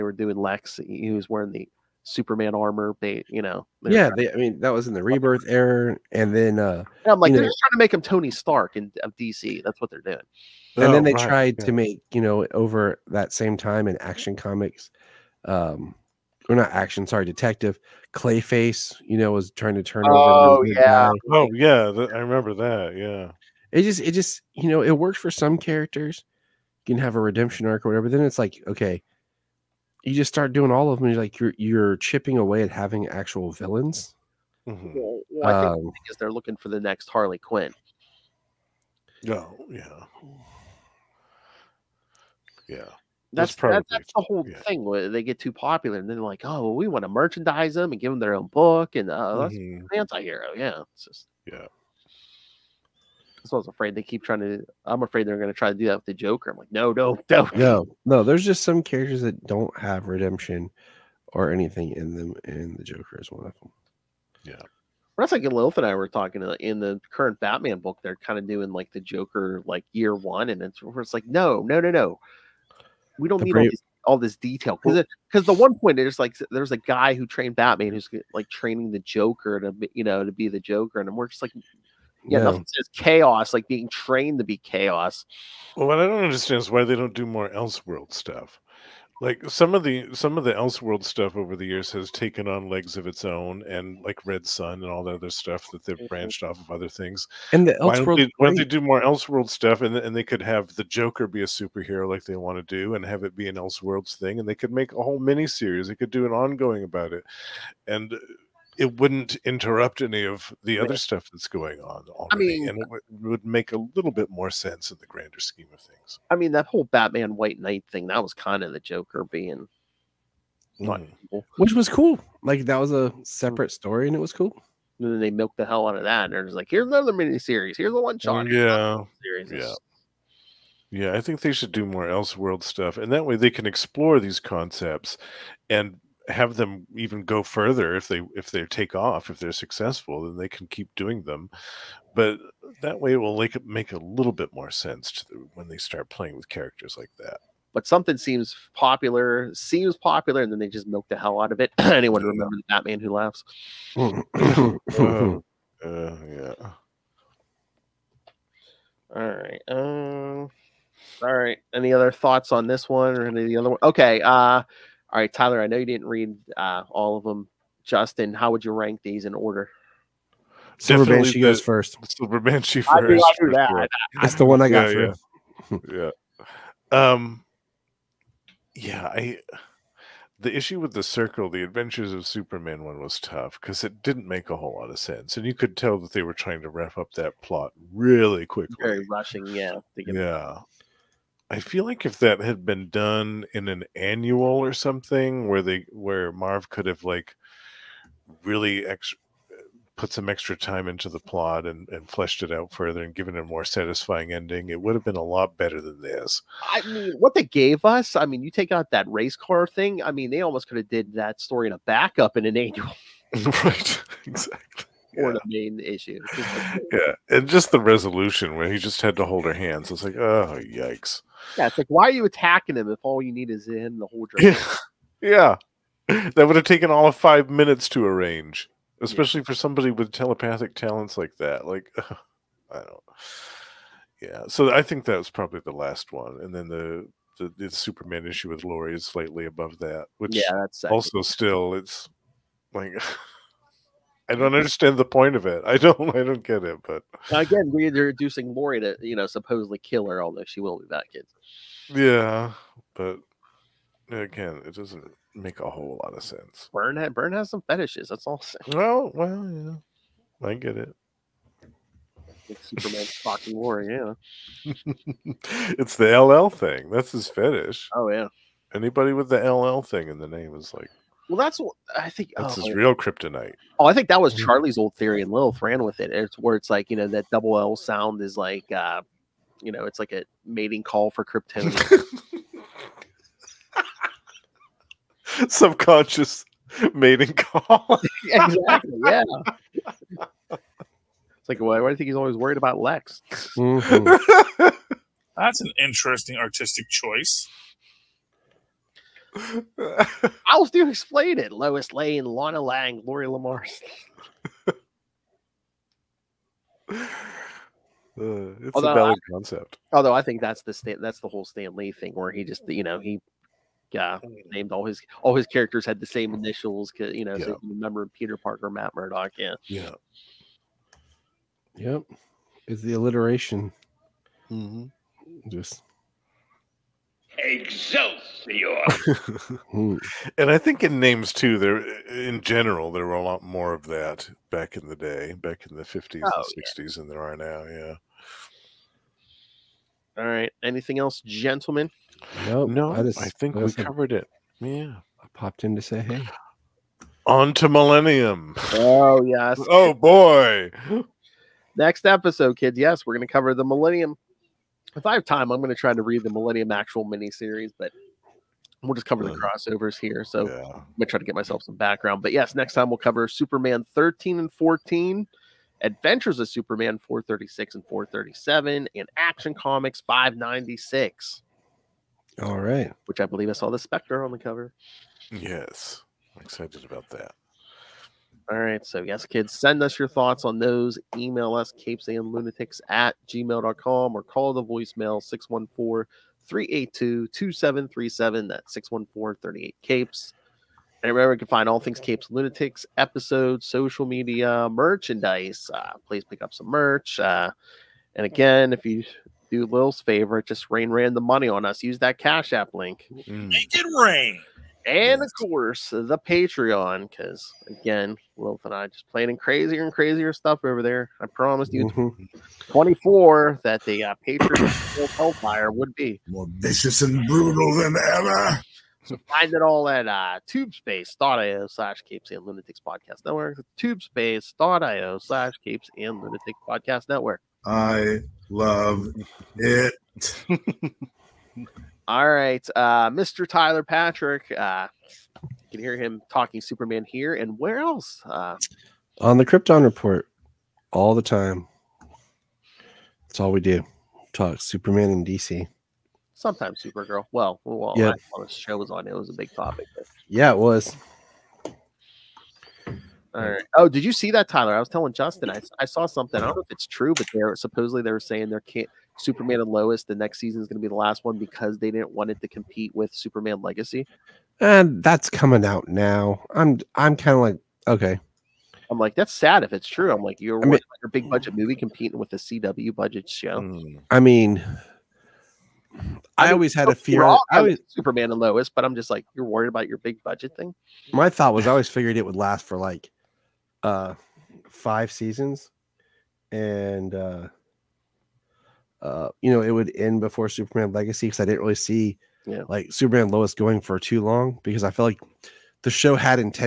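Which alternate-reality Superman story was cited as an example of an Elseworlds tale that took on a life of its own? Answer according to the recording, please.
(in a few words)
Red Sun.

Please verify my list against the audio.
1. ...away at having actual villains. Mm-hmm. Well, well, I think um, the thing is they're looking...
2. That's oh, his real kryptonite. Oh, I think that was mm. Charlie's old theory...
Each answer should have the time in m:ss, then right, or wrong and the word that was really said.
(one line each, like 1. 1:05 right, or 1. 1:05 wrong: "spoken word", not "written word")
1. 0:32 right
2. 4:32 right.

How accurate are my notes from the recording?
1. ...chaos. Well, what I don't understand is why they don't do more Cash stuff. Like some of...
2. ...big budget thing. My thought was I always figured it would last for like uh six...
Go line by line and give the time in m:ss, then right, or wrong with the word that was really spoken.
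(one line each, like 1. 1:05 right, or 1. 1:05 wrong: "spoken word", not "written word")
1. 1:24 wrong: "Elseworld", not "Cash"
2. 7:59 wrong: "five", not "six".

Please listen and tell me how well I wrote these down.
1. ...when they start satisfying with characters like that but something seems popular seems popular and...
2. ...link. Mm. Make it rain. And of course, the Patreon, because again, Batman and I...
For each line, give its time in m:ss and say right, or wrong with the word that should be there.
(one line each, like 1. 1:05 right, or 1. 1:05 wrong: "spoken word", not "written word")
1. 2:25 wrong: "playing", not "satisfying"
2. 6:42 wrong: "Wolf", not "Batman".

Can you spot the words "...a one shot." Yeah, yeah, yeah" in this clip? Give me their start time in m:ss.
2:07.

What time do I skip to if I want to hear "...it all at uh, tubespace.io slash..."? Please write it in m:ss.
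6:59.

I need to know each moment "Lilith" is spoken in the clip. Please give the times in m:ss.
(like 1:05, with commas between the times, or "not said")
1:05, 4:35.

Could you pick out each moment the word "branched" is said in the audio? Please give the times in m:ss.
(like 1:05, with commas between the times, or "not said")
1:36.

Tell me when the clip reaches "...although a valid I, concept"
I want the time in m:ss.
5:08.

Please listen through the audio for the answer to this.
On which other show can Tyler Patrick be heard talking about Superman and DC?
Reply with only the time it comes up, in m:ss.
7:19.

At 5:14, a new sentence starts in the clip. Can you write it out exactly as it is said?
named all his all his characters had the same initials, you know, yeah.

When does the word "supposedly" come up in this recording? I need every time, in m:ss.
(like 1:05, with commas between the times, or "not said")
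4:09, 7:37.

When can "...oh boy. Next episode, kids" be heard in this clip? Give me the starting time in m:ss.
5:49.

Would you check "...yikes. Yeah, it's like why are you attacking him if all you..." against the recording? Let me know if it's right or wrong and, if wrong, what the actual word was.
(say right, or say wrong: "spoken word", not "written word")
right.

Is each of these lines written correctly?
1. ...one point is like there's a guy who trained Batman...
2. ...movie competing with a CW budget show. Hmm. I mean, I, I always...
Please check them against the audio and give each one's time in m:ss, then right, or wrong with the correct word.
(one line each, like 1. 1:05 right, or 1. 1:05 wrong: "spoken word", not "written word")
1. 1:15 right
2. 7:51 right.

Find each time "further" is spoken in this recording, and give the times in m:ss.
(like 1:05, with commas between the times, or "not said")
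2:17, 3:22.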